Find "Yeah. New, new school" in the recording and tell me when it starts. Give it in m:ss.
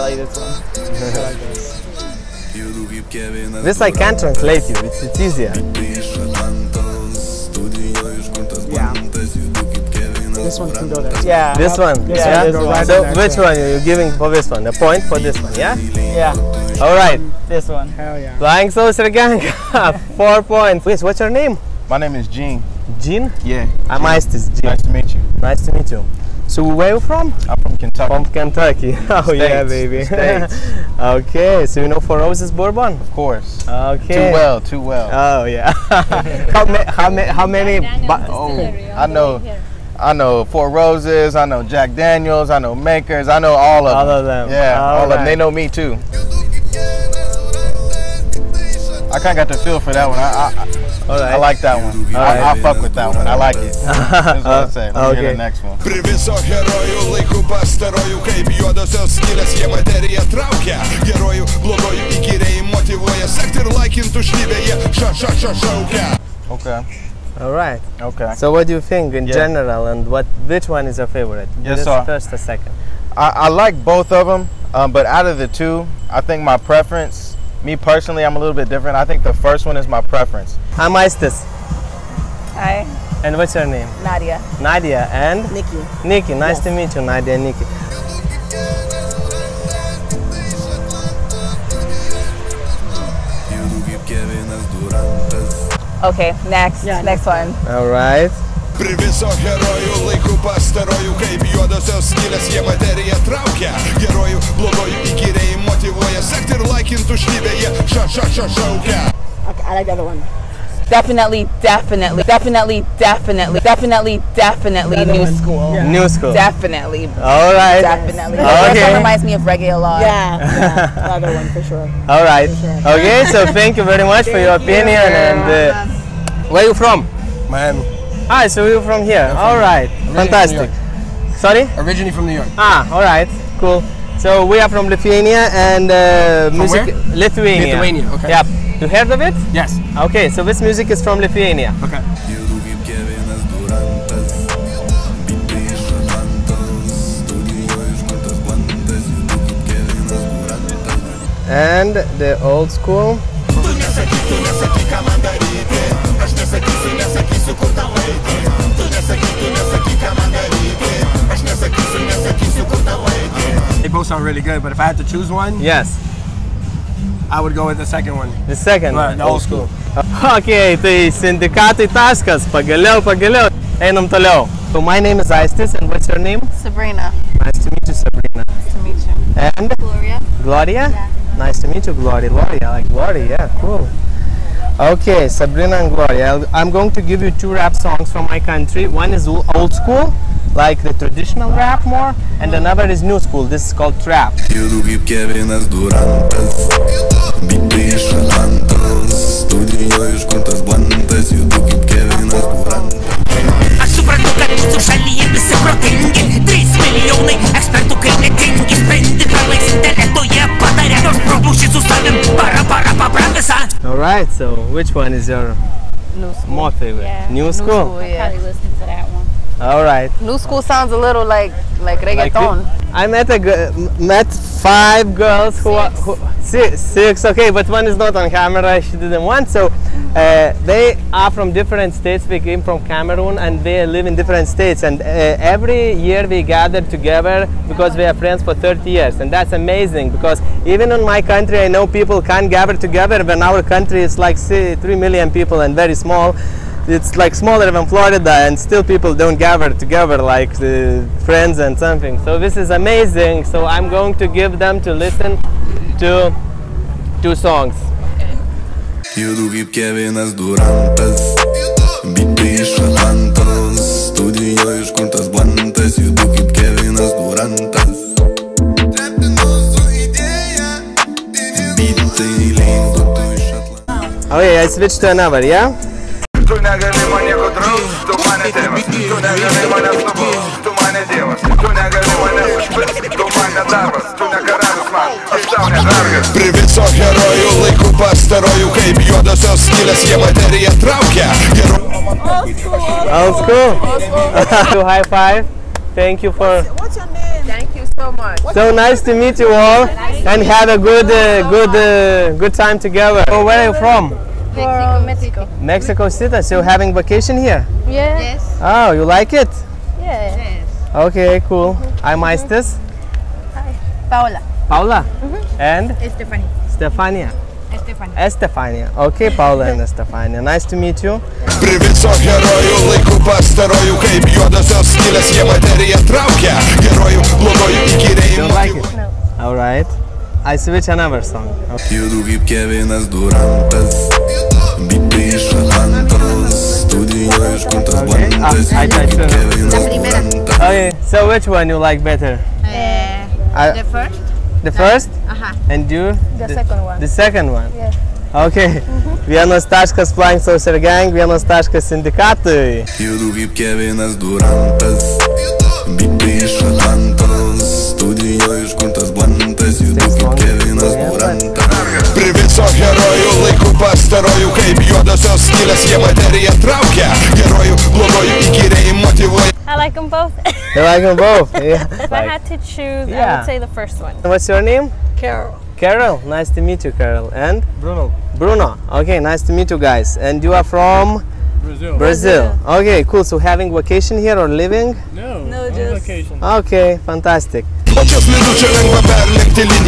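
3:37.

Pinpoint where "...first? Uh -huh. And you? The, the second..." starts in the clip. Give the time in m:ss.
5:44.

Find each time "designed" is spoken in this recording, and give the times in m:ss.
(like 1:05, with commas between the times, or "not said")
not said.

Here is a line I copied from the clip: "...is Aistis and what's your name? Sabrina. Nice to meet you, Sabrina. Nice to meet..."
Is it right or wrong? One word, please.
right.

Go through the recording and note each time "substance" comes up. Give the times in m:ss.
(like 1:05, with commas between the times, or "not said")
not said.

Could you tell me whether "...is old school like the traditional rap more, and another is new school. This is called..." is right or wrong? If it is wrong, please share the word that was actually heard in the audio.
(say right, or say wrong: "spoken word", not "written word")
right.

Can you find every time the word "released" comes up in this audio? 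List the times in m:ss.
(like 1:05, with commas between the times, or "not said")
not said.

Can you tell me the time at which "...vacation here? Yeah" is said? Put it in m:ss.
5:06.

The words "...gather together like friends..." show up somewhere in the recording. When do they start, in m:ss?
4:09.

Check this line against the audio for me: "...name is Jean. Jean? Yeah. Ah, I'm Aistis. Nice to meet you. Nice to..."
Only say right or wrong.
right.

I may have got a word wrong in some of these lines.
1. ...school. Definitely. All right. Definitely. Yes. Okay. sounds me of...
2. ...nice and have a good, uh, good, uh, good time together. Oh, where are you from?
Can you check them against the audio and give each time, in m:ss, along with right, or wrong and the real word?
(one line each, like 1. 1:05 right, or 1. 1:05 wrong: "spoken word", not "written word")
1. 1:56 wrong: "reminds", not "sounds"
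2. 4:59 right.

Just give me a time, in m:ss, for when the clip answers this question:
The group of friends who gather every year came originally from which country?
3:52.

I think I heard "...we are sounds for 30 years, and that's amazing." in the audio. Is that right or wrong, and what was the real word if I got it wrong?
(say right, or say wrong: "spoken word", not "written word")
wrong: "friends", not "sounds".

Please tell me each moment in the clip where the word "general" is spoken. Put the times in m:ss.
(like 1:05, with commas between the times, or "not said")
1:09.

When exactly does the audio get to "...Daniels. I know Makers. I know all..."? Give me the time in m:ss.
0:41.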